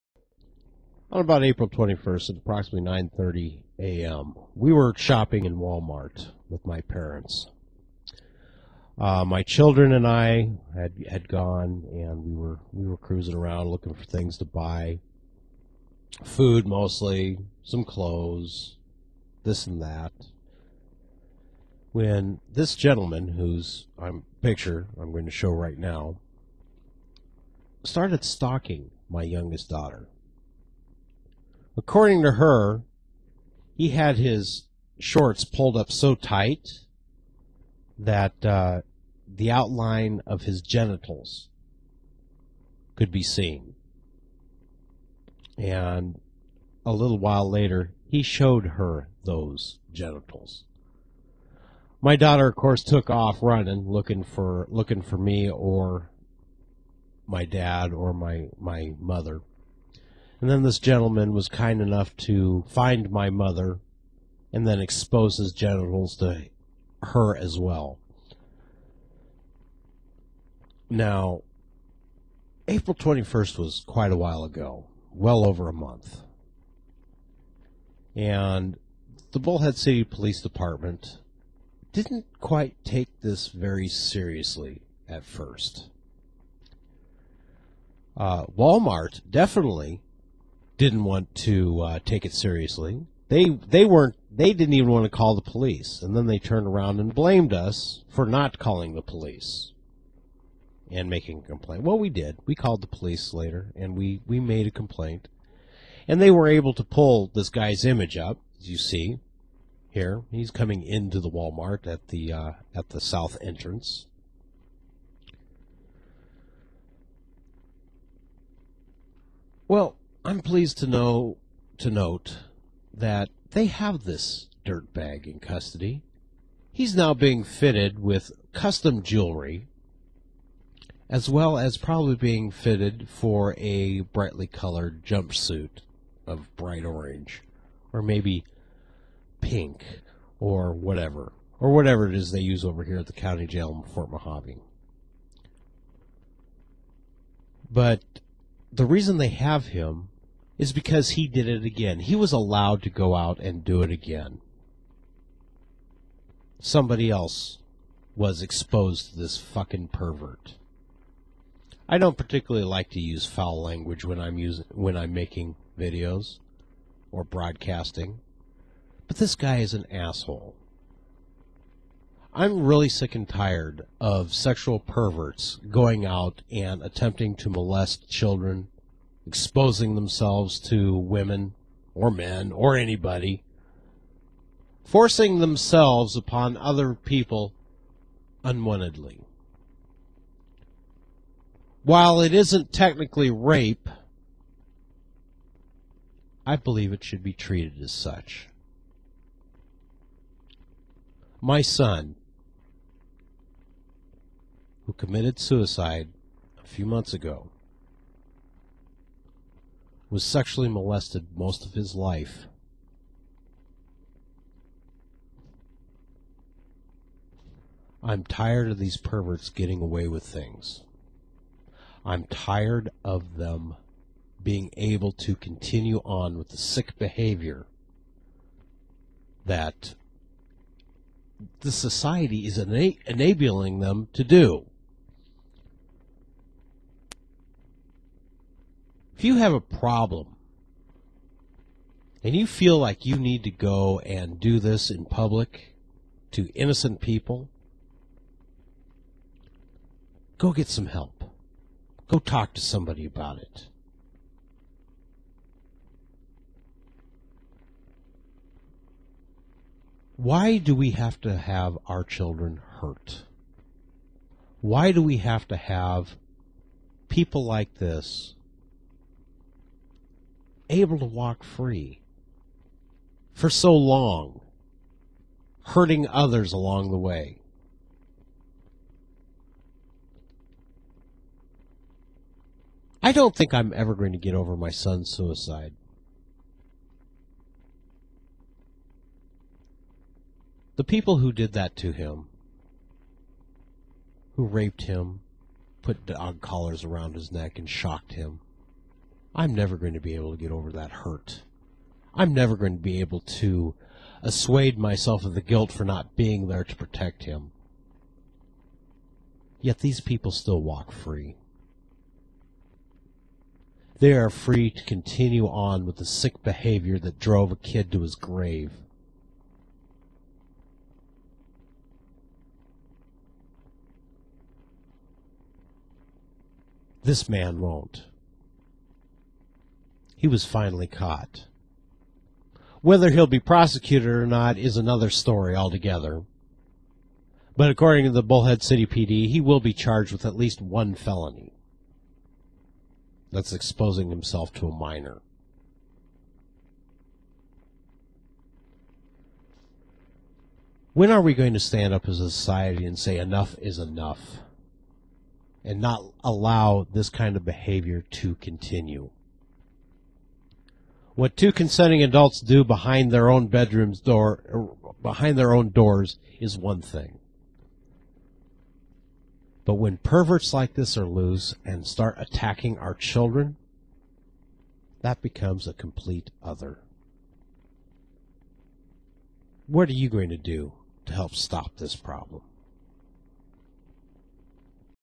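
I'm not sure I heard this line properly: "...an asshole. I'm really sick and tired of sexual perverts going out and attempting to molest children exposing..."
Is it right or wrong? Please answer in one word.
right.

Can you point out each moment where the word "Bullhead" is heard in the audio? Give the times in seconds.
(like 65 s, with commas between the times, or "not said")
79 s, 338 s.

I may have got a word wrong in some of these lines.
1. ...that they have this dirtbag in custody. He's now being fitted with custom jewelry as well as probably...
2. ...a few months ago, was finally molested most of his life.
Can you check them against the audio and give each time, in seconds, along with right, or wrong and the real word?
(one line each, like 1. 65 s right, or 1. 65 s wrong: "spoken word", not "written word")
1. 122 s right
2. 206 s wrong: "sexually", not "finally".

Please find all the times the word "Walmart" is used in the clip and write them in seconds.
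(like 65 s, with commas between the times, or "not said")
5 s, 88 s, 111 s.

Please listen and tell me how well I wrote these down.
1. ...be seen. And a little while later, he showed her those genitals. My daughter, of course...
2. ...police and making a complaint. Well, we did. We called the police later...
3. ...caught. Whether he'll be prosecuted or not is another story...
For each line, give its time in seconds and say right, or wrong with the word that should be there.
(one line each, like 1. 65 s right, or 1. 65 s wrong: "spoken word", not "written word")
1. 43 s right
2. 99 s right
3. 330 s right.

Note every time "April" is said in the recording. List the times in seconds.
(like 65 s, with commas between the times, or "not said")
1 s, 72 s.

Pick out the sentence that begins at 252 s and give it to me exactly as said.
Go talk to somebody about it.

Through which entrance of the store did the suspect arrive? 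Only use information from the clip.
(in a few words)
South entrance.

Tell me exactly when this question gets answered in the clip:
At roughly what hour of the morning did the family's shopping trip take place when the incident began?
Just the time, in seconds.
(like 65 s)
2 s.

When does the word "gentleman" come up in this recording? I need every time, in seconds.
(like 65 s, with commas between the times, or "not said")
22 s, 60 s.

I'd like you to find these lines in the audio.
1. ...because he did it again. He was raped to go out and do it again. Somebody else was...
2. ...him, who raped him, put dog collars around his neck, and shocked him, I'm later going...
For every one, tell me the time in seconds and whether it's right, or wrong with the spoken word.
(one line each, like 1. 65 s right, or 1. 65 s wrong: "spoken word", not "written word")
1. 150 s wrong: "allowed", not "raped"
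2. 291 s wrong: "never", not "later".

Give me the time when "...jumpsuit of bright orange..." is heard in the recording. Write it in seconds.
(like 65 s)
135 s.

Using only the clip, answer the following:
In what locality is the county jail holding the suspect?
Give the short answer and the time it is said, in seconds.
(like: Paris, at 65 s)
Fort Mojave, at 143 s.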